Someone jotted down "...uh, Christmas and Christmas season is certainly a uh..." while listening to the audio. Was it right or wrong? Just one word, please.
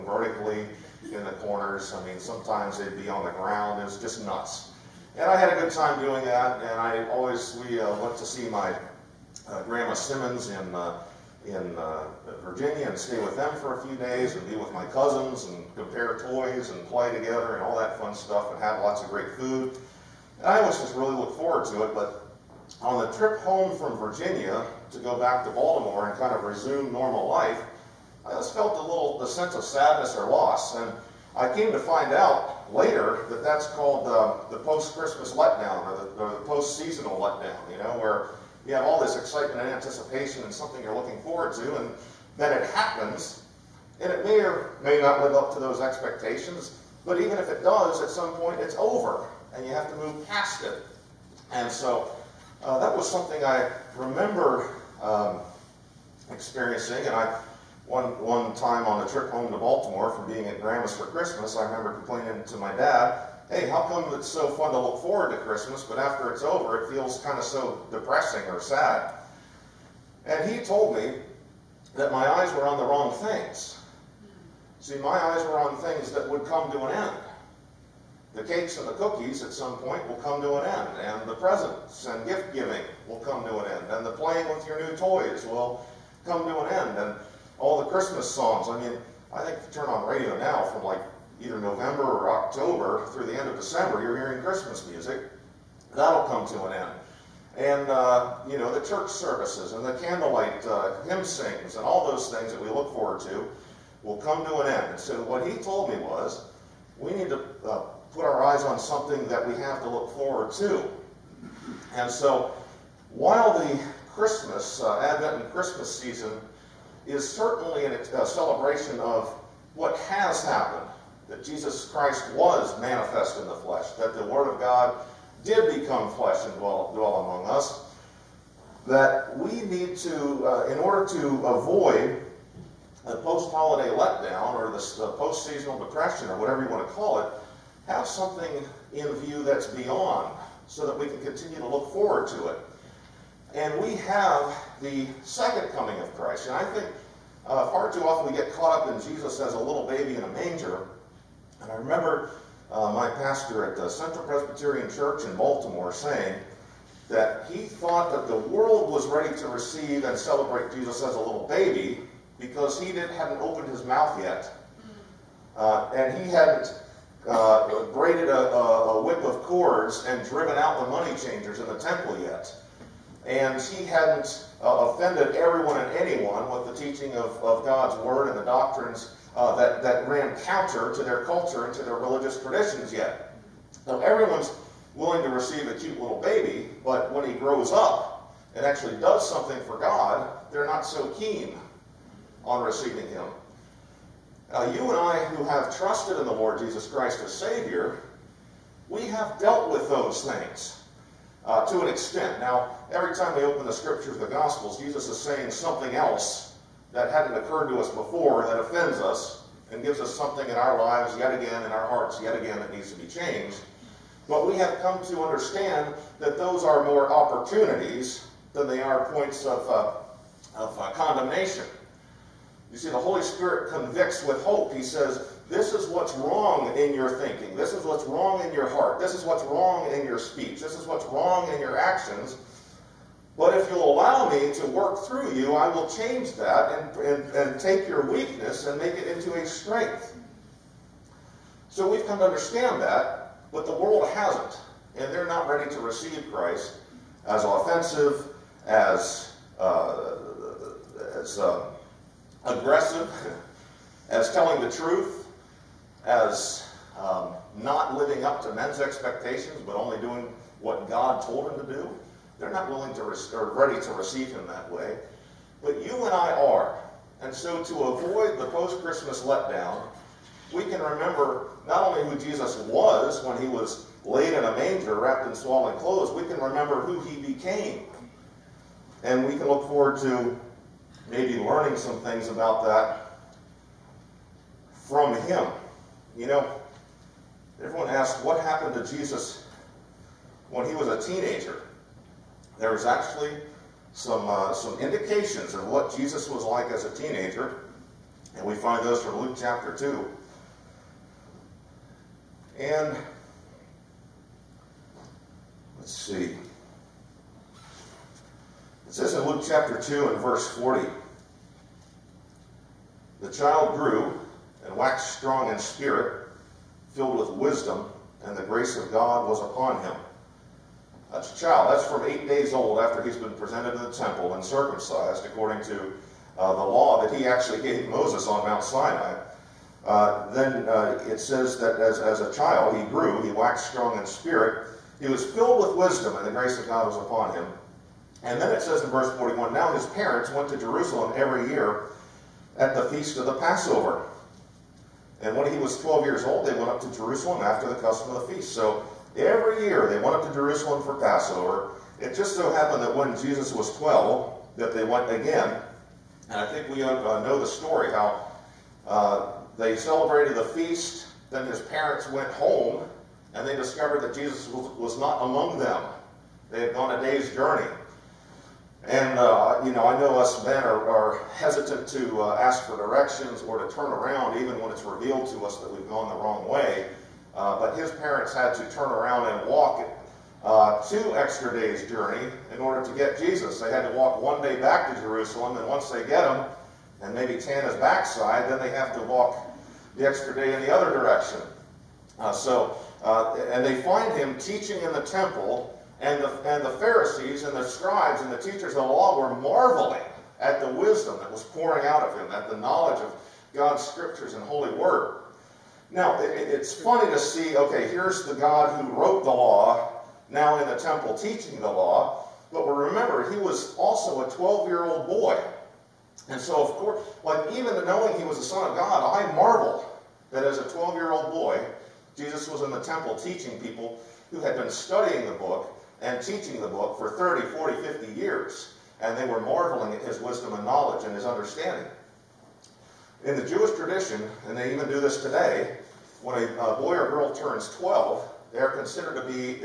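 wrong.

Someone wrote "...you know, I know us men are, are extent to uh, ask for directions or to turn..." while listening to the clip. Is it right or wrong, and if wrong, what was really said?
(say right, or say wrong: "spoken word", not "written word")
wrong: "hesitant", not "extent".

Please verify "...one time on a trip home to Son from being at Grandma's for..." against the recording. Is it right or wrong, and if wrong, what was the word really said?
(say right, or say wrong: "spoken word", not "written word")
wrong: "Baltimore", not "Son".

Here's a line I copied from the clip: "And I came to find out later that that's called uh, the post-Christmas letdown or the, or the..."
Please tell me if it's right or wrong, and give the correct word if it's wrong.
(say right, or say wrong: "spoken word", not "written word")
right.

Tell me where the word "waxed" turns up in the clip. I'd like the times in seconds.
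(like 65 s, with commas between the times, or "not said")
314 s, 333 s.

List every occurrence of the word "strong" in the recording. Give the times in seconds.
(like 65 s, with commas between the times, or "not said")
315 s, 333 s.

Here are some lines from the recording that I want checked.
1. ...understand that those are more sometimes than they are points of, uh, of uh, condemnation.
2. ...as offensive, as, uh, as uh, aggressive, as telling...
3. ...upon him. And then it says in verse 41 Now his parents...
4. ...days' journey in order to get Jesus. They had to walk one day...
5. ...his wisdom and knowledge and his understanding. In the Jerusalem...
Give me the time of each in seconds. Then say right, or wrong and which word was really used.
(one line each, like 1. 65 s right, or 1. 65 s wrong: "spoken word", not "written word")
1. 215 s wrong: "opportunities", not "sometimes"
2. 247 s right
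3. 336 s right
4. 381 s right
5. 430 s wrong: "Jewish", not "Jerusalem".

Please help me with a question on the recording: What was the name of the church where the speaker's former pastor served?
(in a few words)
Central Presbyterian Church.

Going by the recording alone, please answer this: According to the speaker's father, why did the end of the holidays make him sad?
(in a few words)
eyes were on the wrong things.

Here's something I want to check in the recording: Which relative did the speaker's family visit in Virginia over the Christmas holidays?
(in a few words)
Grandma Simmons.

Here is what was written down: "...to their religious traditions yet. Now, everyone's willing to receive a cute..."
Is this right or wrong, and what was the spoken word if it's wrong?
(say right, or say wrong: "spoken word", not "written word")
right.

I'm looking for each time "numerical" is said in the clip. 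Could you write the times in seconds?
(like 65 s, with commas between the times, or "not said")
not said.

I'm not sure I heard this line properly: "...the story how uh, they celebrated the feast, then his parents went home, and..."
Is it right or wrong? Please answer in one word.
right.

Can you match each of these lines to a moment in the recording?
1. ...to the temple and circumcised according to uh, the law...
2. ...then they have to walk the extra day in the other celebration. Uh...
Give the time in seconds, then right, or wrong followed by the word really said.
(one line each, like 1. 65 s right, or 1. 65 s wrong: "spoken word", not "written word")
1. 323 s right
2. 388 s wrong: "direction", not "celebration".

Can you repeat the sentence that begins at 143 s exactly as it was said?
And we have the second coming of Christ.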